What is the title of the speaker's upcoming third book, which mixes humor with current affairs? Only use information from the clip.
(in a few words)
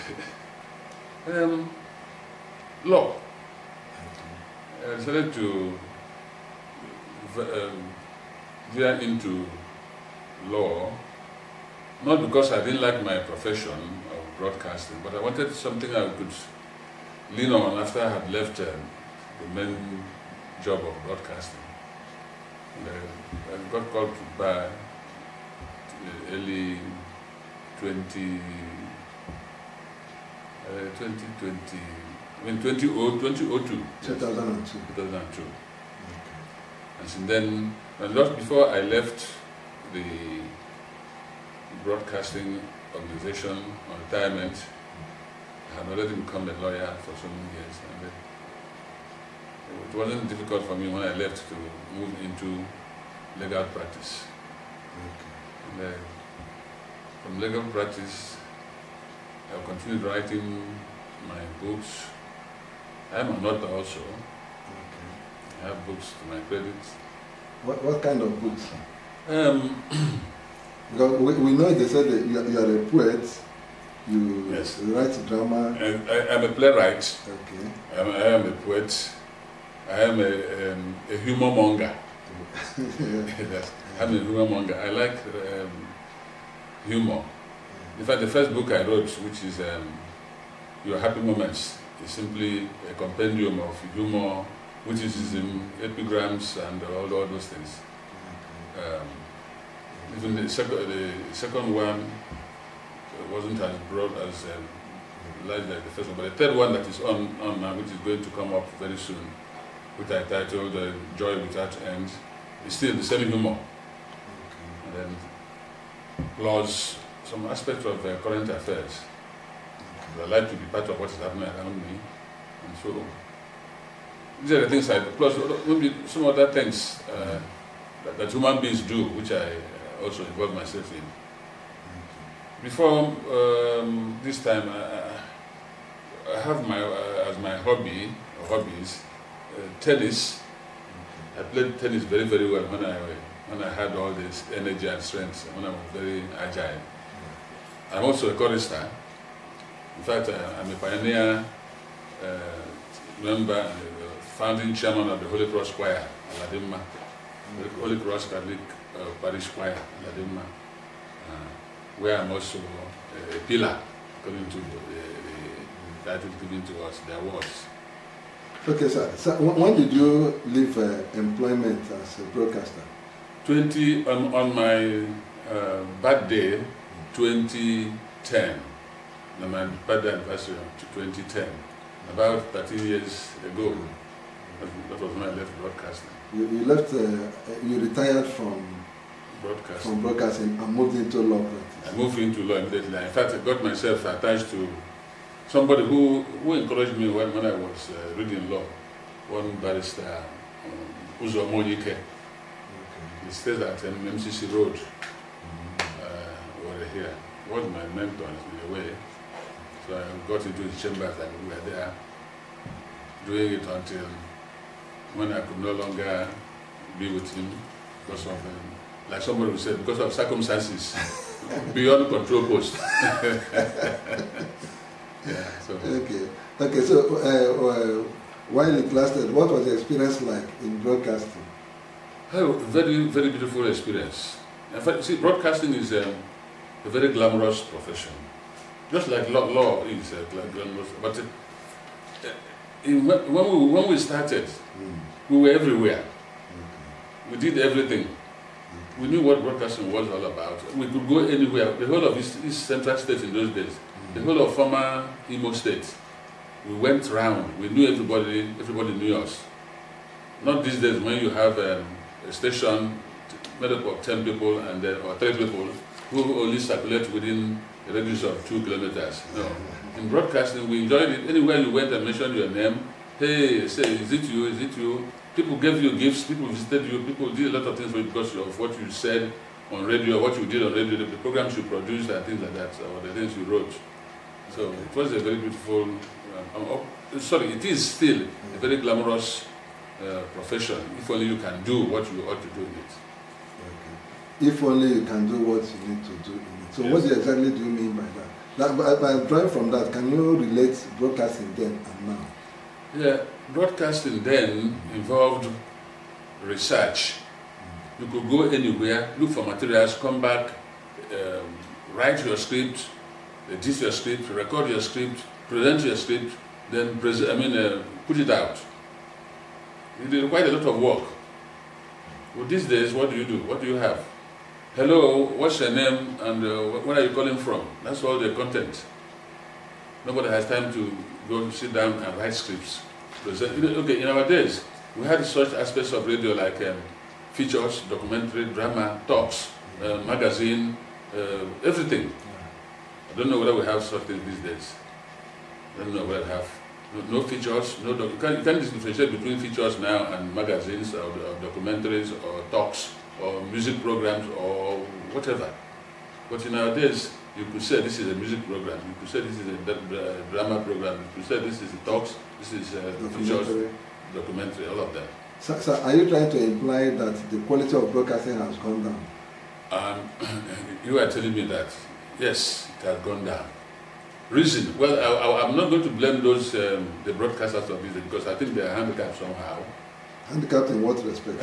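Joy Without End.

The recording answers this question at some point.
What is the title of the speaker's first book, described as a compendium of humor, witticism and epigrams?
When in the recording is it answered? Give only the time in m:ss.
1:30.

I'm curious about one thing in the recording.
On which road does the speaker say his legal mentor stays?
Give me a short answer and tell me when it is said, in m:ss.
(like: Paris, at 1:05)
MCC Road, at 3:23.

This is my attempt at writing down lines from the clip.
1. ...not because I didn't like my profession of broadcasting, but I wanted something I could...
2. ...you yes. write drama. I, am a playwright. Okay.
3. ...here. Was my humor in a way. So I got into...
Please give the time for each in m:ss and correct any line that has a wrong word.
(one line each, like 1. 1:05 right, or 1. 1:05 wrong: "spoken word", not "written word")
1. 0:12 right
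2. 1:14 right
3. 3:26 wrong: "mentor", not "humor".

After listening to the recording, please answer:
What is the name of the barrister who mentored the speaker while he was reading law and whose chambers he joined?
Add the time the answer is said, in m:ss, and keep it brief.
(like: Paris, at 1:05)
Uzo Monyike, at 3:21.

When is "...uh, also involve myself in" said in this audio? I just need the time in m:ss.
2:09.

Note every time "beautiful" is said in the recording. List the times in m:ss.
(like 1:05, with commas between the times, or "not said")
3:53, 4:45.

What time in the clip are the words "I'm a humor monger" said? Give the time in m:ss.
1:23.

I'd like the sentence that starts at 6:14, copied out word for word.
Reason, well, I, am not going to blame those, um, the broadcasters of music, because I think they are handicapped somehow.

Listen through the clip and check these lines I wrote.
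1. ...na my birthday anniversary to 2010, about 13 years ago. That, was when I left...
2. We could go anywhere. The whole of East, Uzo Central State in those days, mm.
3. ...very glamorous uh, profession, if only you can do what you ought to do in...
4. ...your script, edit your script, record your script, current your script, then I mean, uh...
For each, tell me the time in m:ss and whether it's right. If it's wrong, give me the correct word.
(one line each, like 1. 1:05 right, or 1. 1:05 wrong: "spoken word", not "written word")
1. 2:59 right
2. 4:10 wrong: "East", not "Uzo"
3. 4:48 right
4. 5:12 wrong: "present", not "current".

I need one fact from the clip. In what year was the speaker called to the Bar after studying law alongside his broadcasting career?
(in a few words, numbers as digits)
2002.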